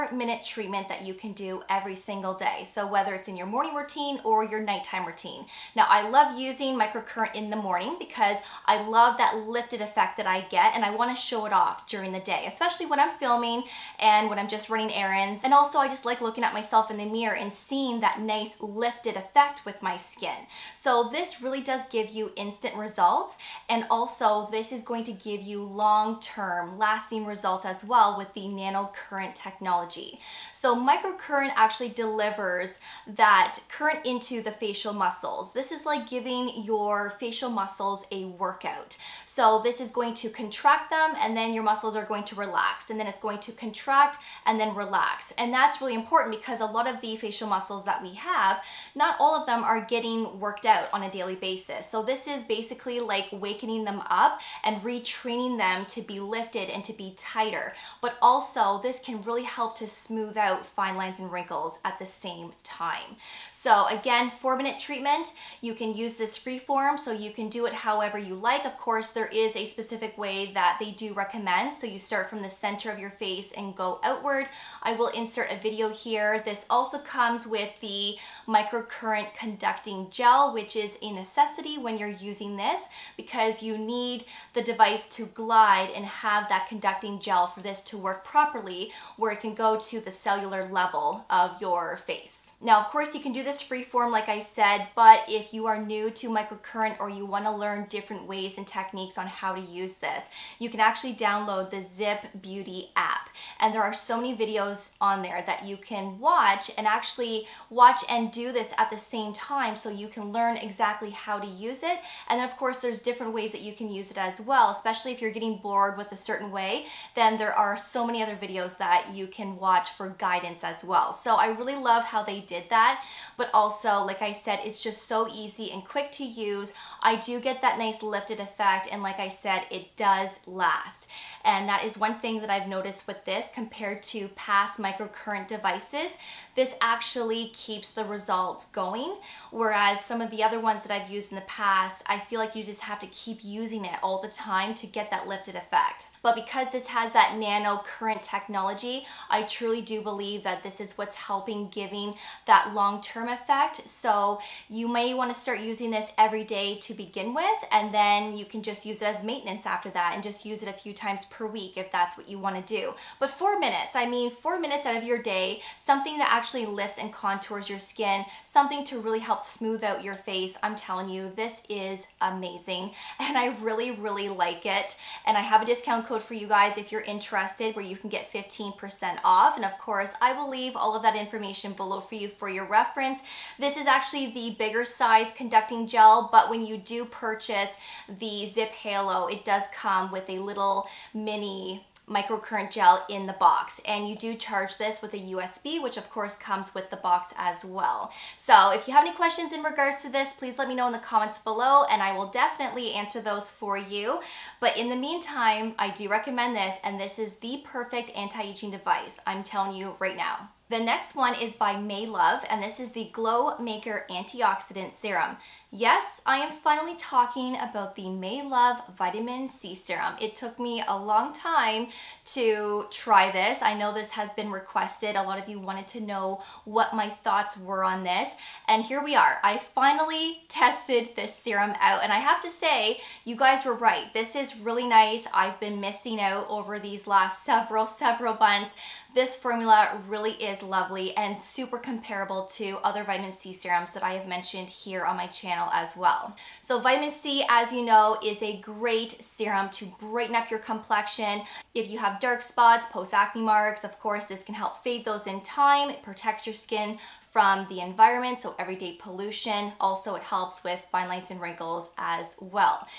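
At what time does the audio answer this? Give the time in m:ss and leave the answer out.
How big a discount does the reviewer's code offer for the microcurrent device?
2:58.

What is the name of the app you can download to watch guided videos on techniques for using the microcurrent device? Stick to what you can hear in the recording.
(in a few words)
ZIIP Beauty app.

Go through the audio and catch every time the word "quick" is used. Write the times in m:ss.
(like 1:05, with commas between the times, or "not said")
2:05.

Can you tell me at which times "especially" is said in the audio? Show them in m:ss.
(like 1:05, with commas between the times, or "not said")
0:12, 1:54.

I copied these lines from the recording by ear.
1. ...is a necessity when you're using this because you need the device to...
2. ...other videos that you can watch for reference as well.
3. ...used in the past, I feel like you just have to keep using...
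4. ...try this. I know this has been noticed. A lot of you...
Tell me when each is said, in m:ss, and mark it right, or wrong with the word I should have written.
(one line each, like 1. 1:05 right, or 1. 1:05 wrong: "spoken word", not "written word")
1. 1:20 right
2. 1:58 wrong: "guidance", not "reference"
3. 2:21 right
4. 3:42 wrong: "requested", not "noticed".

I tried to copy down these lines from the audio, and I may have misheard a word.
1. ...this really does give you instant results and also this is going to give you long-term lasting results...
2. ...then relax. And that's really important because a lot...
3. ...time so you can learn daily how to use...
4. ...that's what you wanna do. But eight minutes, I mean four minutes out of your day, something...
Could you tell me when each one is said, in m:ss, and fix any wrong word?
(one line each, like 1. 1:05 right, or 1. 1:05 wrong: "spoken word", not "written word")
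1. 0:21 right
2. 0:44 right
3. 1:49 wrong: "exactly", not "daily"
4. 2:41 wrong: "four", not "eight".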